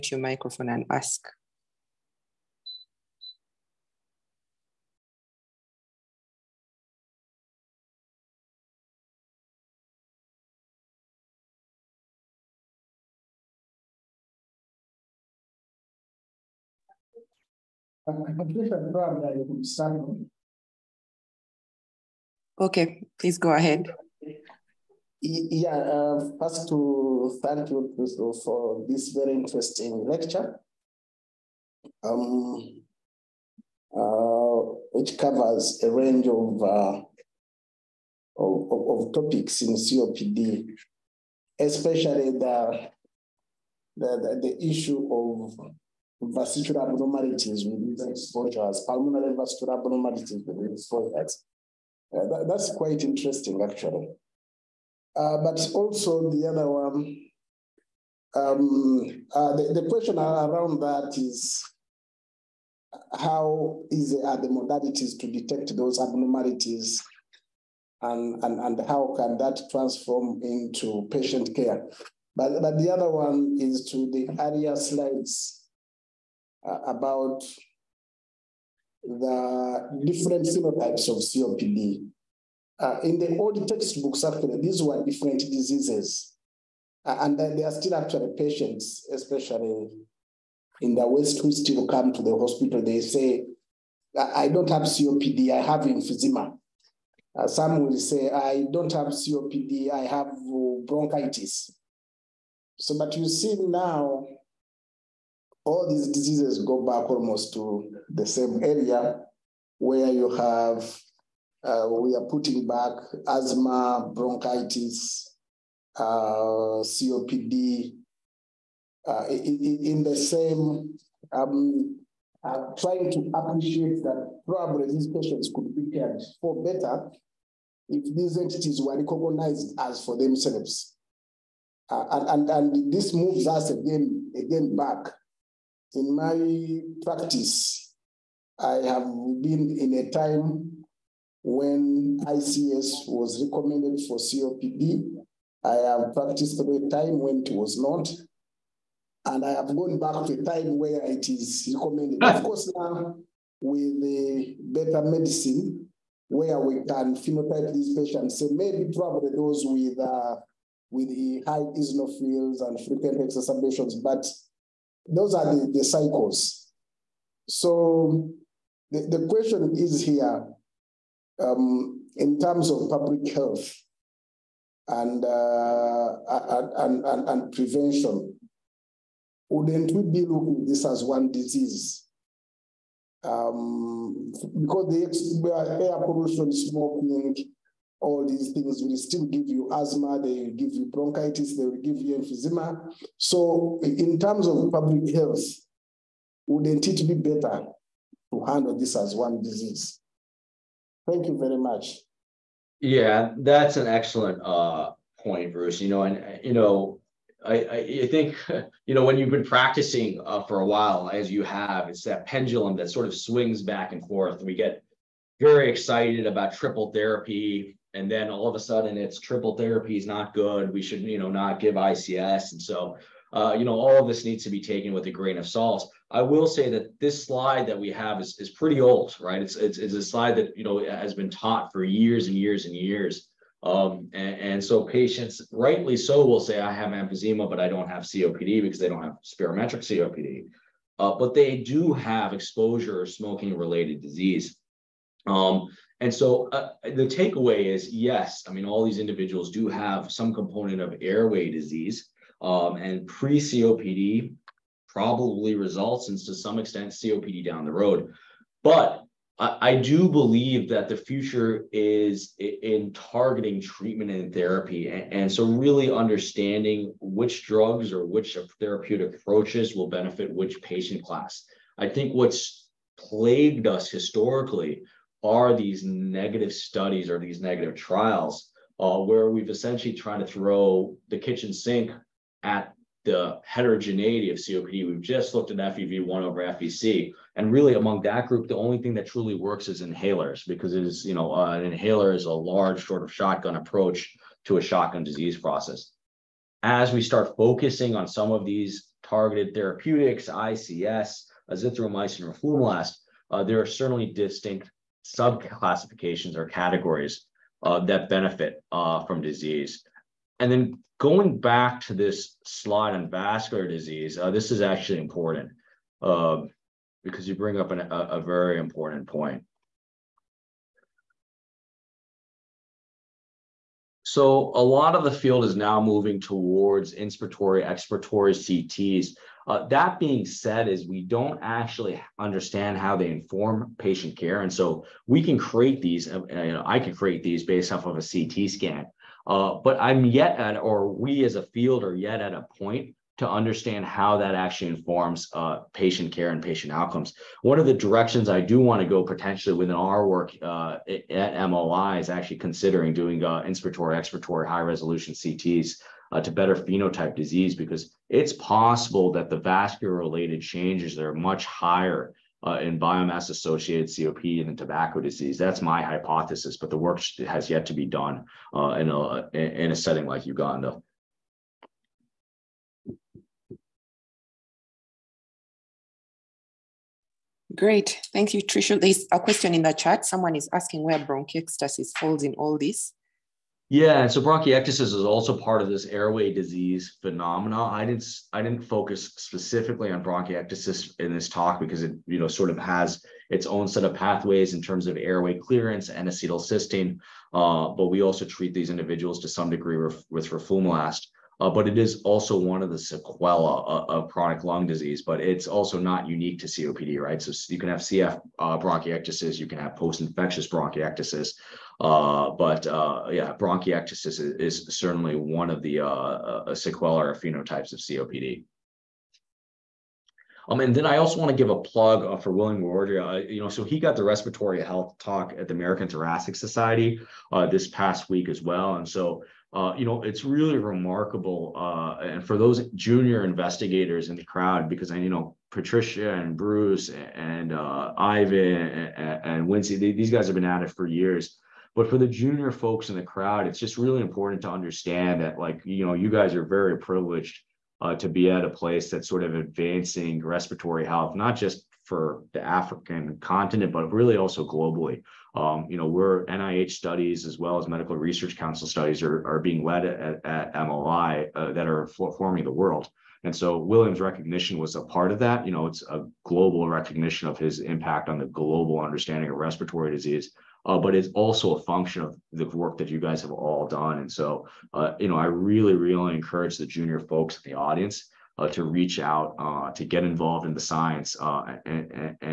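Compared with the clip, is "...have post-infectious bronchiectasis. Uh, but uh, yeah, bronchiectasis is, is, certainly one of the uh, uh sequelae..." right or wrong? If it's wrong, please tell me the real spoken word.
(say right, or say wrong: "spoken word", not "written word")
right.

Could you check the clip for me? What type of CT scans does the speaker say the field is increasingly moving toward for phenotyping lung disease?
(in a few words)
Inspiratory, expiratory CTs.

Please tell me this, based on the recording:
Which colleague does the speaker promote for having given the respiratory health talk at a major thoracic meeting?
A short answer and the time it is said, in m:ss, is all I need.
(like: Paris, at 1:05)
William Worodria, at 7:02.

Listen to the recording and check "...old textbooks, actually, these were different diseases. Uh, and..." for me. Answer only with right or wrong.
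right.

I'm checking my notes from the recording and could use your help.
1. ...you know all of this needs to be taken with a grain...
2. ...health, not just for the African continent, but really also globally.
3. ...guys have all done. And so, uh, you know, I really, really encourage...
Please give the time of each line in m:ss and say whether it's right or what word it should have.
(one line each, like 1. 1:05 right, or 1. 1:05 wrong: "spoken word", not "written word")
1. 3:43 right
2. 7:30 right
3. 7:52 right.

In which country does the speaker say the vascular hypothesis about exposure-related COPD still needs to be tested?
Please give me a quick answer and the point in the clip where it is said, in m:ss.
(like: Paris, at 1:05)
Uganda, at 6:10.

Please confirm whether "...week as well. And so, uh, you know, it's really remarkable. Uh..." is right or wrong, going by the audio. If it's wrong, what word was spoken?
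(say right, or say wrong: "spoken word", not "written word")
right.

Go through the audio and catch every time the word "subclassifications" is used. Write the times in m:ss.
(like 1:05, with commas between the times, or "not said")
5:05.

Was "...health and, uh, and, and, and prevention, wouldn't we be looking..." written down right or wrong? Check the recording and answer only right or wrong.
right.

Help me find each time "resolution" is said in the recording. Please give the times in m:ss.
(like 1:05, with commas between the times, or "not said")
5:54.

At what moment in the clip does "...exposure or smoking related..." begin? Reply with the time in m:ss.
4:02.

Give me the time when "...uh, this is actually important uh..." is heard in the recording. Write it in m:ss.
5:14.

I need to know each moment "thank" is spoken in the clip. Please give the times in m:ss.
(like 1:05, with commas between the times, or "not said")
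0:27, 3:21, 6:18.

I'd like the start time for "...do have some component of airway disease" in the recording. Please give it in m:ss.
4:09.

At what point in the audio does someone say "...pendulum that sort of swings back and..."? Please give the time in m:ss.
3:32.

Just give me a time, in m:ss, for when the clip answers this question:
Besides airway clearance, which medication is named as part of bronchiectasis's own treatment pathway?
6:36.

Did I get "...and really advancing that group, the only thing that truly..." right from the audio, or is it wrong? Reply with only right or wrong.
wrong.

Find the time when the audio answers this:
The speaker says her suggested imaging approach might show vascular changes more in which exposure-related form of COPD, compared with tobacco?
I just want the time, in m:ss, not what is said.
6:02.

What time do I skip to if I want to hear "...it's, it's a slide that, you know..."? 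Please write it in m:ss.
3:49.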